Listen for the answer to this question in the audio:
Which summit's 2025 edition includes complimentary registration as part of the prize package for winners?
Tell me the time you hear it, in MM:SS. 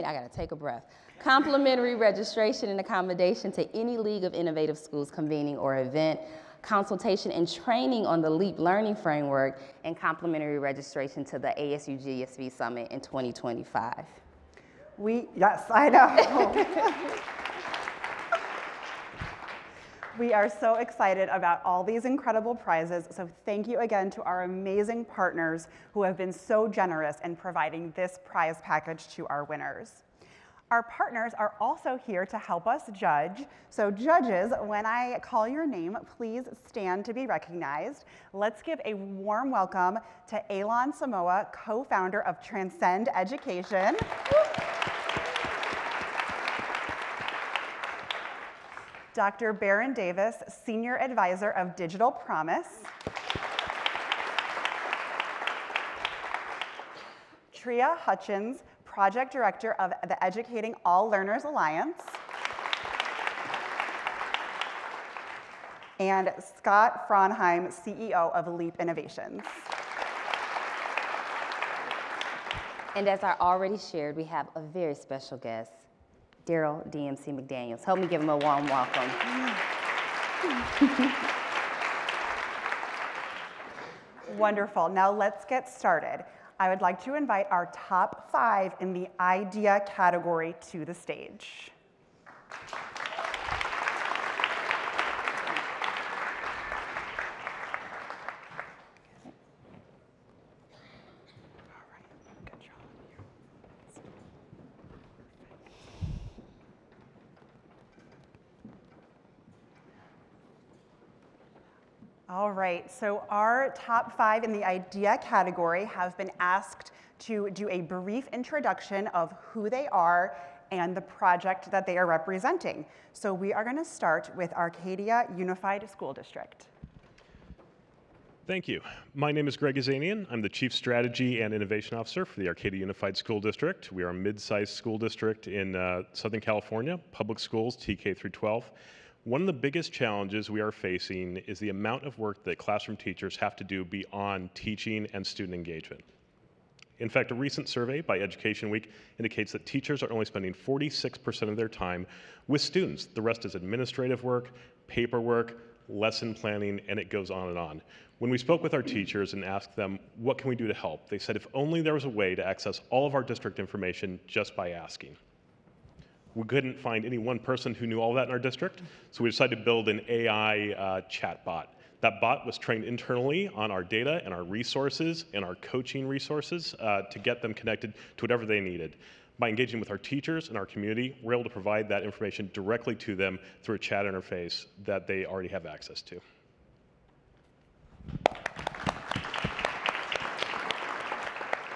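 00:11.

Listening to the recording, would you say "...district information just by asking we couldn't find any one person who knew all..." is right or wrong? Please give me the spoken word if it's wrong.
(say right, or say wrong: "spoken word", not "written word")
right.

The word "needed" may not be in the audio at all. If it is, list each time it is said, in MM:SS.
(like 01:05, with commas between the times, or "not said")
02:58.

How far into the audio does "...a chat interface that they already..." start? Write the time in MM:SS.
03:03.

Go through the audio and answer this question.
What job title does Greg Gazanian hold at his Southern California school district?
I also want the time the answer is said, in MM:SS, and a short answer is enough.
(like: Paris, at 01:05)
Chief Strategy and Innovation Officer, at 02:10.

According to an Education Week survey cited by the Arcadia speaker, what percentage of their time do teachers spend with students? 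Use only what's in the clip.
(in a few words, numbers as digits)
46%.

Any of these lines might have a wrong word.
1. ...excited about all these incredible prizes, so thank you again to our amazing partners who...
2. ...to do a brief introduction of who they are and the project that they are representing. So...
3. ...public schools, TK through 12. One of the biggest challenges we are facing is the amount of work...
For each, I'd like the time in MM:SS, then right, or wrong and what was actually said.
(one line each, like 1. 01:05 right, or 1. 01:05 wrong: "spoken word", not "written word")
1. 00:20 right
2. 01:57 right
3. 02:17 right.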